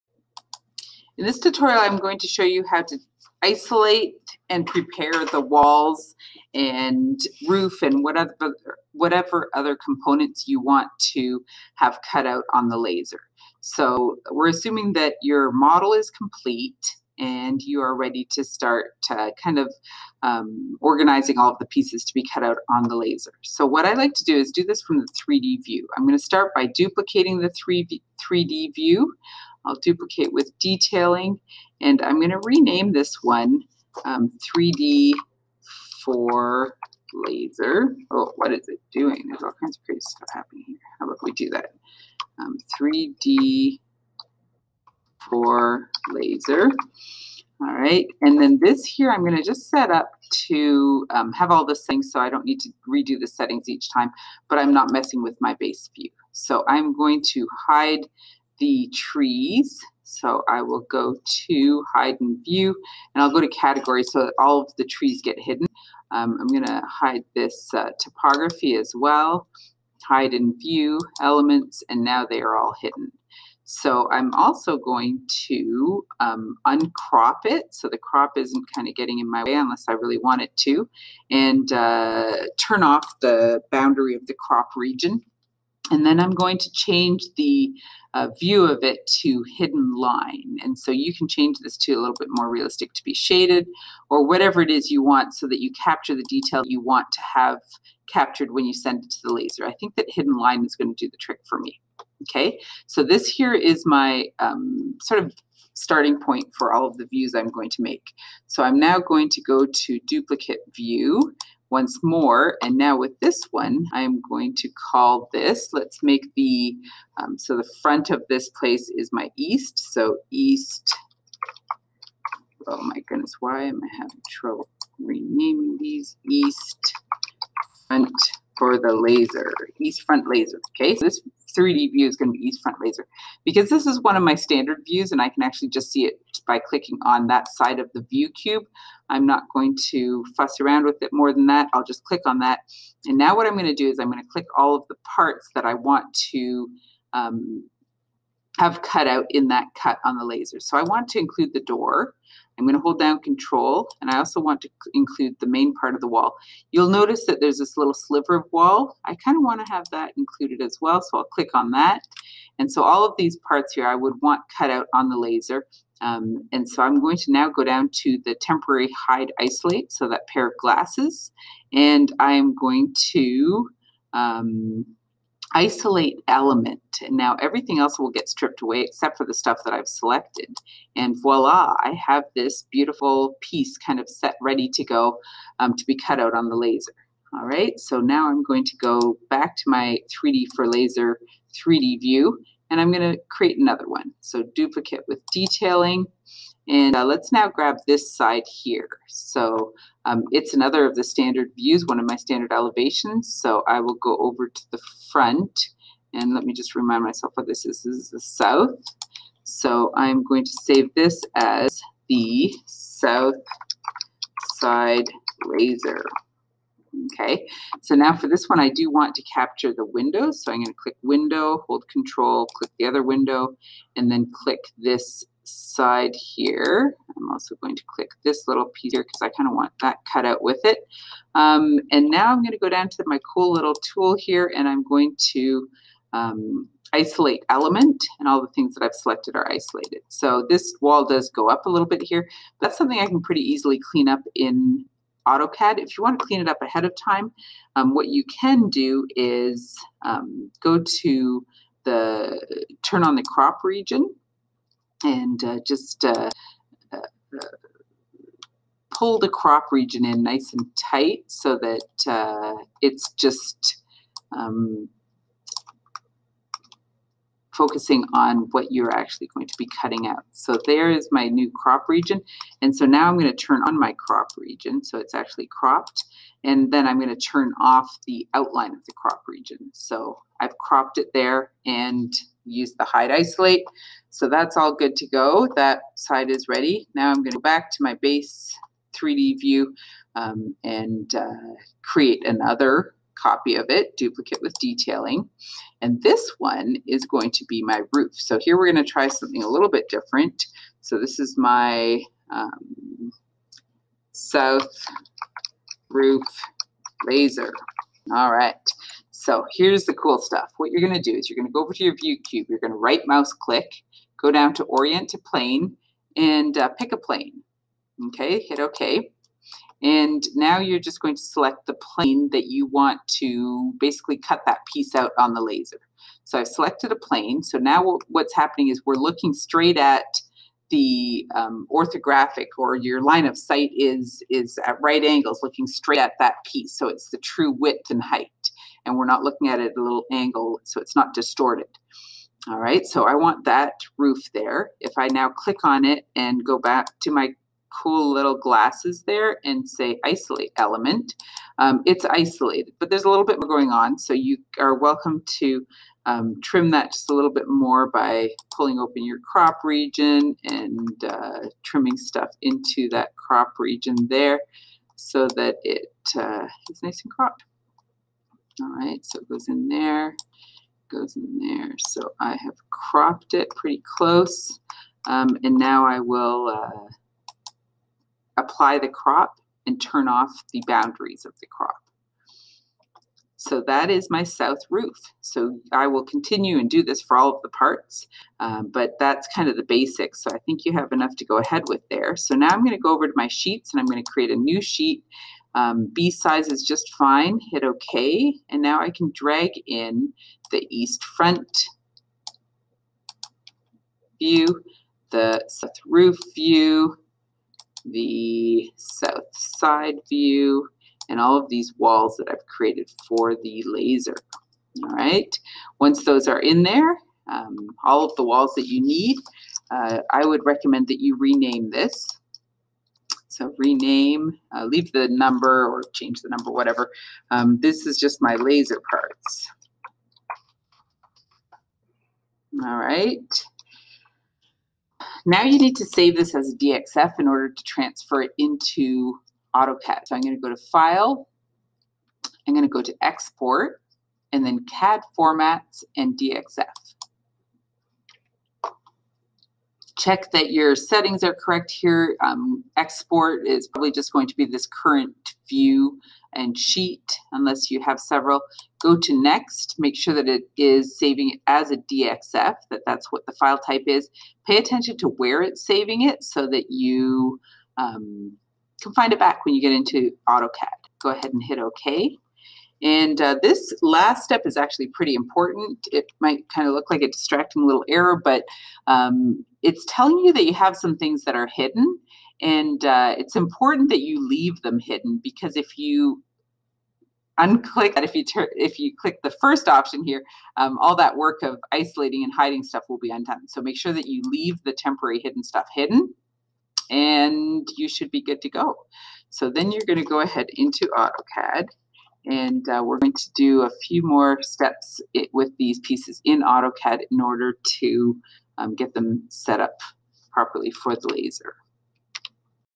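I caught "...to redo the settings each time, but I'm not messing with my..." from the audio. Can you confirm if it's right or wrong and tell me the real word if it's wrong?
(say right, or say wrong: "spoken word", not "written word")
right.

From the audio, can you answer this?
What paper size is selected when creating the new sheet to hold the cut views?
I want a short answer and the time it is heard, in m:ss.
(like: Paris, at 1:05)
B size, at 6:35.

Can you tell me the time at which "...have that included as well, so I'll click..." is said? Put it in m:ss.
2:39.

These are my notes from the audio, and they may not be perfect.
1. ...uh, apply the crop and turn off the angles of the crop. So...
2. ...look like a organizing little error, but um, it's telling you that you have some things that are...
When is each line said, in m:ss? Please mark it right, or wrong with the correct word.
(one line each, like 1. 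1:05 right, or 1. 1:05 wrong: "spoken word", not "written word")
1. 6:16 wrong: "boundaries", not "angles"
2. 7:56 wrong: "distracting", not "organizing".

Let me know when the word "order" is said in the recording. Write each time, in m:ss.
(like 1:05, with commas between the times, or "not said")
7:17, 8:27.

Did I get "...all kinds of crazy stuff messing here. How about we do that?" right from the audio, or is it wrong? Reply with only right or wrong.
wrong.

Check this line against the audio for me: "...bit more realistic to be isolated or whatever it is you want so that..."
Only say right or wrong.
wrong.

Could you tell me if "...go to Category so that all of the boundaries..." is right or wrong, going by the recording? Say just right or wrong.
wrong.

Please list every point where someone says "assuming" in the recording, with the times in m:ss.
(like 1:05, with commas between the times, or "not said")
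0:14.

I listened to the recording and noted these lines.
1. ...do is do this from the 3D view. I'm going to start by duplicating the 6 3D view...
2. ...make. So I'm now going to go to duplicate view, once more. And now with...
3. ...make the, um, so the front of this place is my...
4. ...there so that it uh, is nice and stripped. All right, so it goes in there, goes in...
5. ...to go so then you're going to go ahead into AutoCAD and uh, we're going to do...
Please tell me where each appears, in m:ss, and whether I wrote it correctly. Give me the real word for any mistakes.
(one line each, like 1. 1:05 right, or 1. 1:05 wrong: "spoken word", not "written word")
1. 0:24 wrong: "3", not "6"
2. 1:47 right
3. 1:56 right
4. 6:04 wrong: "cropped", not "stripped"
5. 8:18 right.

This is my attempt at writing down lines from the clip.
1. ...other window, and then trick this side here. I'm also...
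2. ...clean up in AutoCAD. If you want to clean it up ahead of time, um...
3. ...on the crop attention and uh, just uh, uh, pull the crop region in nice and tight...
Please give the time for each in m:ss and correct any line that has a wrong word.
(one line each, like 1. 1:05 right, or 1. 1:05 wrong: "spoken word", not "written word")
1. 3:42 wrong: "click", not "trick"
2. 4:03 right
3. 4:13 wrong: "region", not "attention".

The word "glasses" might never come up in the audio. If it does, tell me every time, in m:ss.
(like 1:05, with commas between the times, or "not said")
2:50, 5:48.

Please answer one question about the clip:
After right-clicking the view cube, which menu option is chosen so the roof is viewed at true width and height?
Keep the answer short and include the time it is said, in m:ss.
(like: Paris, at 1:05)
Orient to plane, at 5:14.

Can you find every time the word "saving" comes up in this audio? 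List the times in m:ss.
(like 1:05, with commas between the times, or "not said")
7:40, 7:45.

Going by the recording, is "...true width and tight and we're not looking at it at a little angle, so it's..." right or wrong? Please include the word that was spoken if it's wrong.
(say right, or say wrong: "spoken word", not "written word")
wrong: "height", not "tight".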